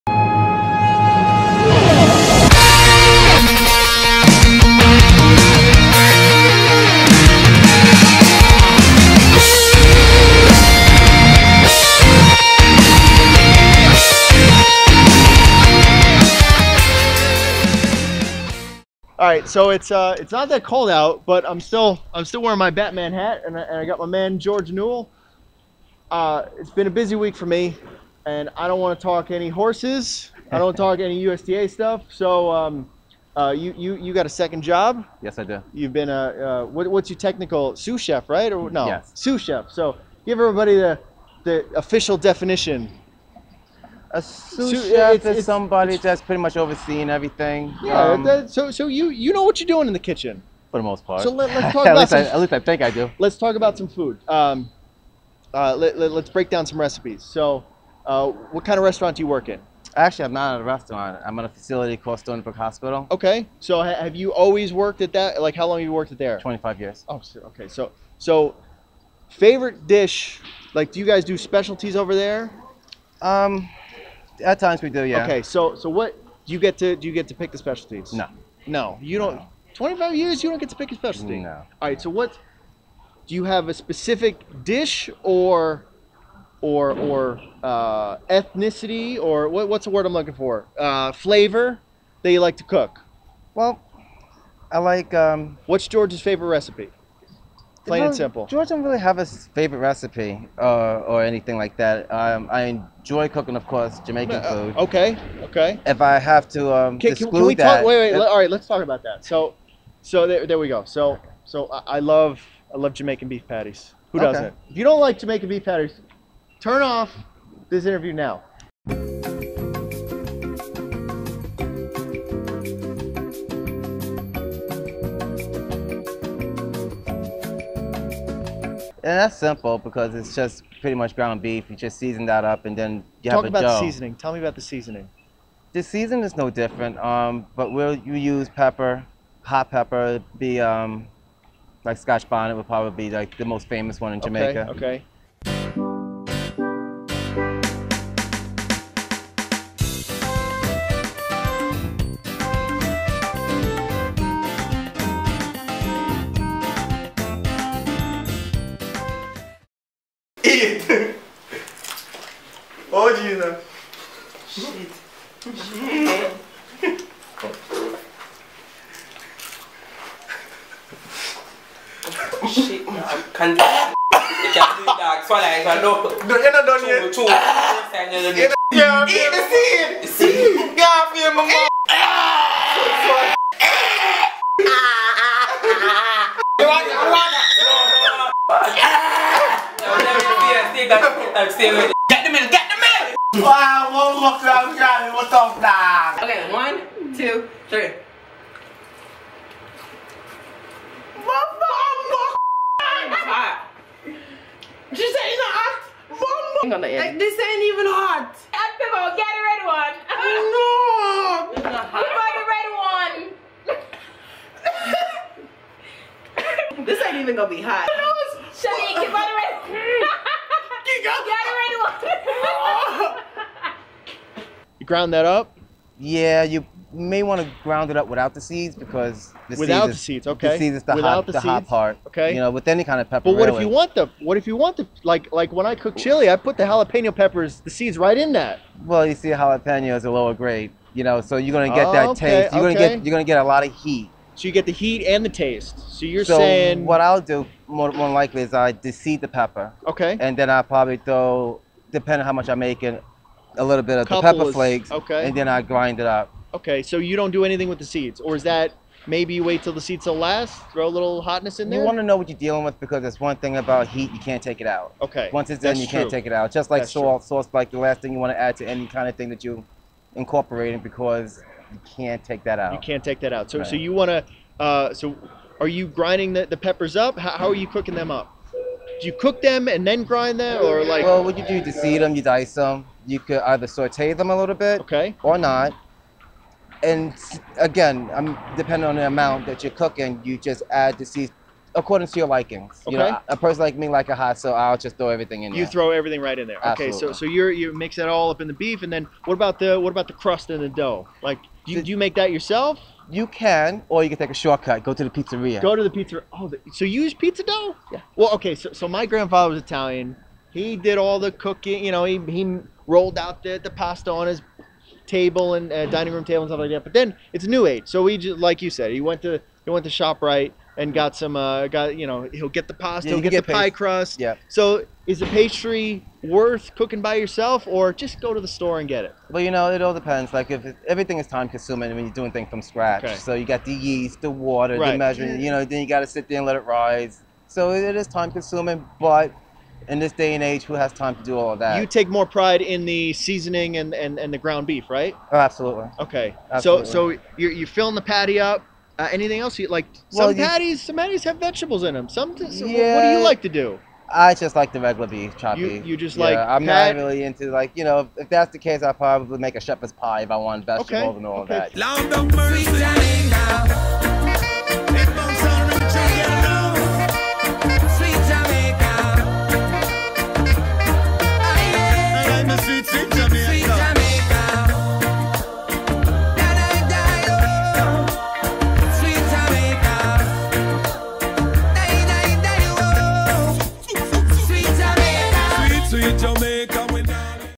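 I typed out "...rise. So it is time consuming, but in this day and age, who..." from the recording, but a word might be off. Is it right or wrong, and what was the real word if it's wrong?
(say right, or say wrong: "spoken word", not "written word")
right.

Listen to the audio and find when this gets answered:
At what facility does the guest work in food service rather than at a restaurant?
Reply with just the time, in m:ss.
1:02.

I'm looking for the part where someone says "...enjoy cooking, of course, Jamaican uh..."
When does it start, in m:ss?
1:42.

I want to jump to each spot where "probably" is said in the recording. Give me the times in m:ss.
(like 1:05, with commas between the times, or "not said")
2:22, 4:10, 5:58.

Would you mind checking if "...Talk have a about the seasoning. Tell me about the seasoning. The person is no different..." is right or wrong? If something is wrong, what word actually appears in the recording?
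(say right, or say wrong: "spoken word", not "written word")
wrong: "season", not "person".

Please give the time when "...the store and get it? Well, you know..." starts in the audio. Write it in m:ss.
5:28.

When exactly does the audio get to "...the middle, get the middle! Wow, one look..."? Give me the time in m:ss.
3:12.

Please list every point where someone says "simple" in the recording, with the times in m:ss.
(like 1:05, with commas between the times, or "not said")
1:38, 2:09.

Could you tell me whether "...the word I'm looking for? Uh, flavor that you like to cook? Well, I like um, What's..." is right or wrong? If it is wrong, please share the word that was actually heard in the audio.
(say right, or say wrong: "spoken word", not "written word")
right.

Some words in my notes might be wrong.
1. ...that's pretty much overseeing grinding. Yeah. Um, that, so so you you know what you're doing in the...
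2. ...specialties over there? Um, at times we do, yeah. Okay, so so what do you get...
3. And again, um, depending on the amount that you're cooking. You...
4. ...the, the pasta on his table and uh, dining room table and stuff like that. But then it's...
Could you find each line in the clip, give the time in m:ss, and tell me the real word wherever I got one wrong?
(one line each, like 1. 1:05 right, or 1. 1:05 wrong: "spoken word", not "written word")
1. 0:46 wrong: "everything", not "grinding"
2. 1:11 right
3. 4:46 right
4. 5:13 right.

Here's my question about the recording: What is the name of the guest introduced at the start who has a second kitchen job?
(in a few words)
George Newell.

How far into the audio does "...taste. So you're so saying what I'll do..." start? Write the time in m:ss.
4:05.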